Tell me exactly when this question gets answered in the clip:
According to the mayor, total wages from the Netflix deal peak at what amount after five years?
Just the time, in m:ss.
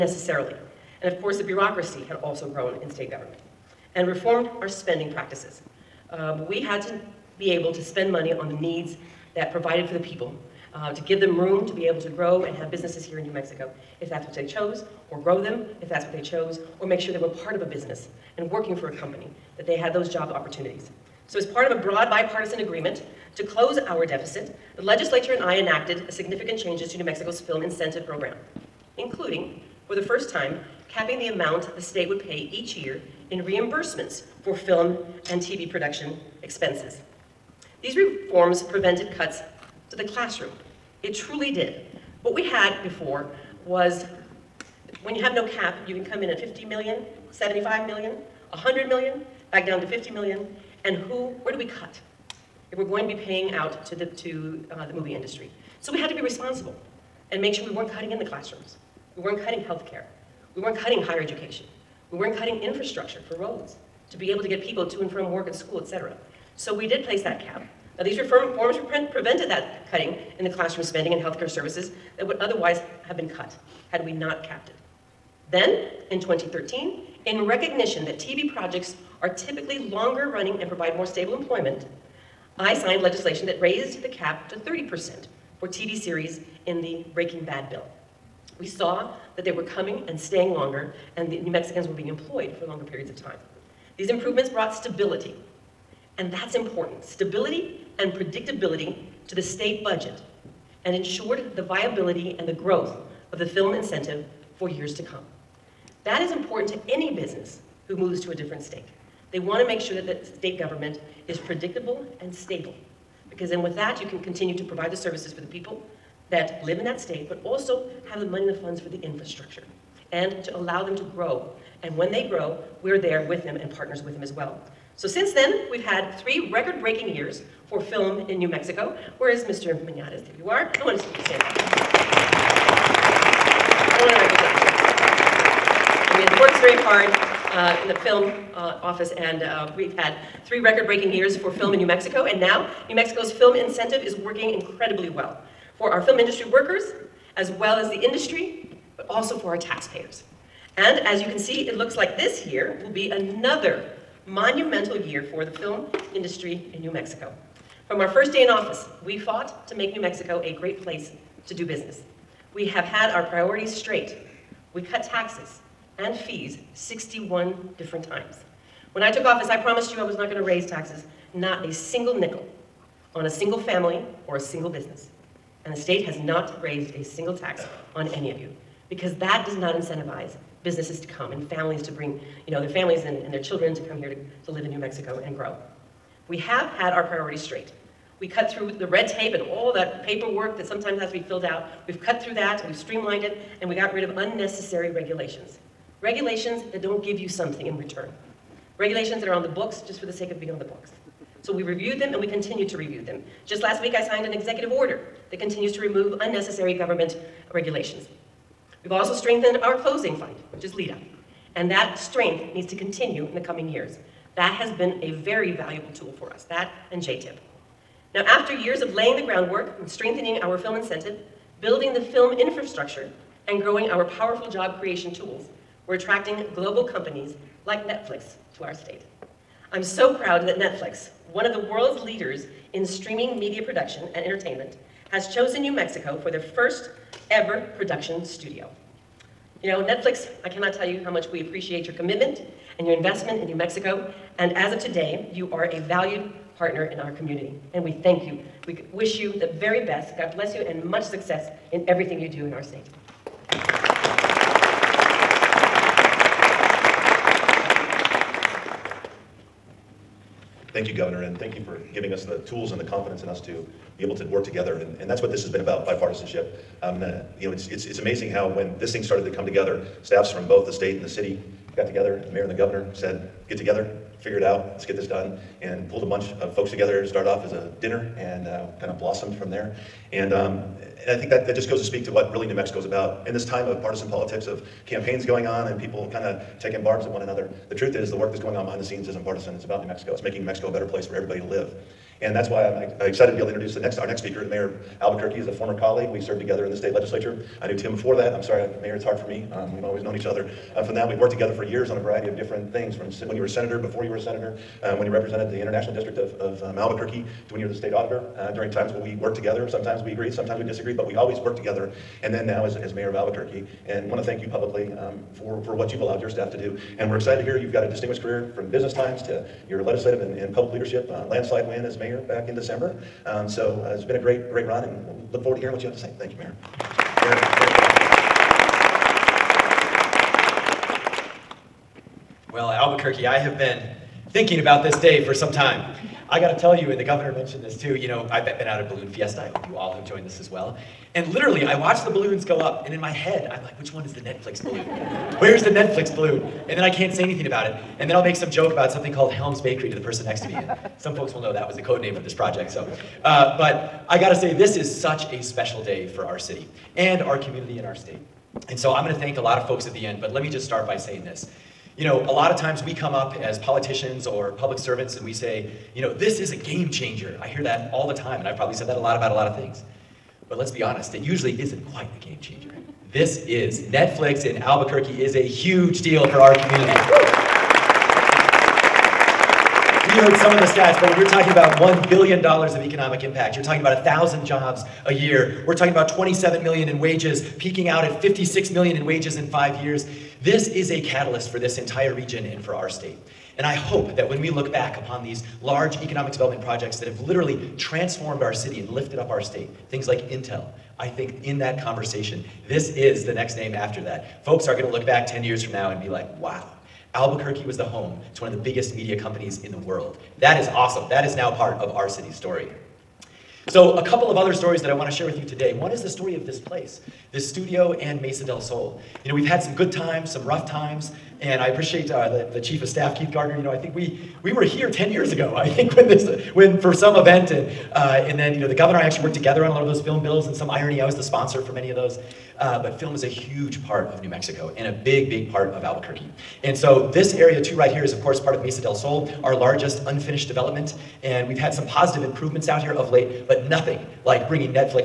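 6:28.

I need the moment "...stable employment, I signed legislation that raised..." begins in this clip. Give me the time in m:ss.
1:21.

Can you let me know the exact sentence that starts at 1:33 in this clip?
These improvements brought stability and that's important.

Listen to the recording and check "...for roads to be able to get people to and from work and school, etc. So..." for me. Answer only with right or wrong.
right.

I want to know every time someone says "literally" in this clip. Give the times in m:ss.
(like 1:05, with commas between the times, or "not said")
5:41, 6:37.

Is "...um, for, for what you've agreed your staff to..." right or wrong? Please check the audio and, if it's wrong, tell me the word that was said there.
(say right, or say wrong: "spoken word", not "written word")
wrong: "allowed", not "agreed".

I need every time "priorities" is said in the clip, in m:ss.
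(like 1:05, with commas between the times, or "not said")
2:43, 3:07.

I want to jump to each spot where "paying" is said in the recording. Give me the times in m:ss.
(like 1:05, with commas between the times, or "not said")
0:53.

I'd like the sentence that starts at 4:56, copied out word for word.
We served together in the state legislature.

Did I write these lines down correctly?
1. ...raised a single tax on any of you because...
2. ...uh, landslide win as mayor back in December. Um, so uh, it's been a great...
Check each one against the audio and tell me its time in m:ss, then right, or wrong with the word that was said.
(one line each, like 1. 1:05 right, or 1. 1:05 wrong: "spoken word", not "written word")
1. 2:56 right
2. 5:21 right.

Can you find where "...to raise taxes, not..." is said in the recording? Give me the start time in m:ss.
2:50.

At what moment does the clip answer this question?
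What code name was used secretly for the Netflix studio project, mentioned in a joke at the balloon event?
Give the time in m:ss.
5:49.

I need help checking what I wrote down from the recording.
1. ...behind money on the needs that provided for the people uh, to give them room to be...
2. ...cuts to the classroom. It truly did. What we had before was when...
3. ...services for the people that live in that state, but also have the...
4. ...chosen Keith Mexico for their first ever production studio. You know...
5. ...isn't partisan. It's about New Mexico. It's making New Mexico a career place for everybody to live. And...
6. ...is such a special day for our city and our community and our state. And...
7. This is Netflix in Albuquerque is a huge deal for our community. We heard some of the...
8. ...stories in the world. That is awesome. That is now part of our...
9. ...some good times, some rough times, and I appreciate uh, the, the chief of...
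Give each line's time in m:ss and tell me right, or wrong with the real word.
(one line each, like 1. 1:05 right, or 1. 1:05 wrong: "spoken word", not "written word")
1. 0:07 wrong: "spend", not "behind"
2. 0:39 right
3. 1:54 right
4. 3:55 wrong: "New", not "Keith"
5. 4:49 wrong: "better", not "career"
6. 5:54 right
7. 6:13 right
8. 6:49 wrong: "companies", not "stories"
9. 6:59 right.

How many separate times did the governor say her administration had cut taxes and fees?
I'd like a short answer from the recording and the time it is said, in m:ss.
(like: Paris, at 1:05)
61, at 2:46.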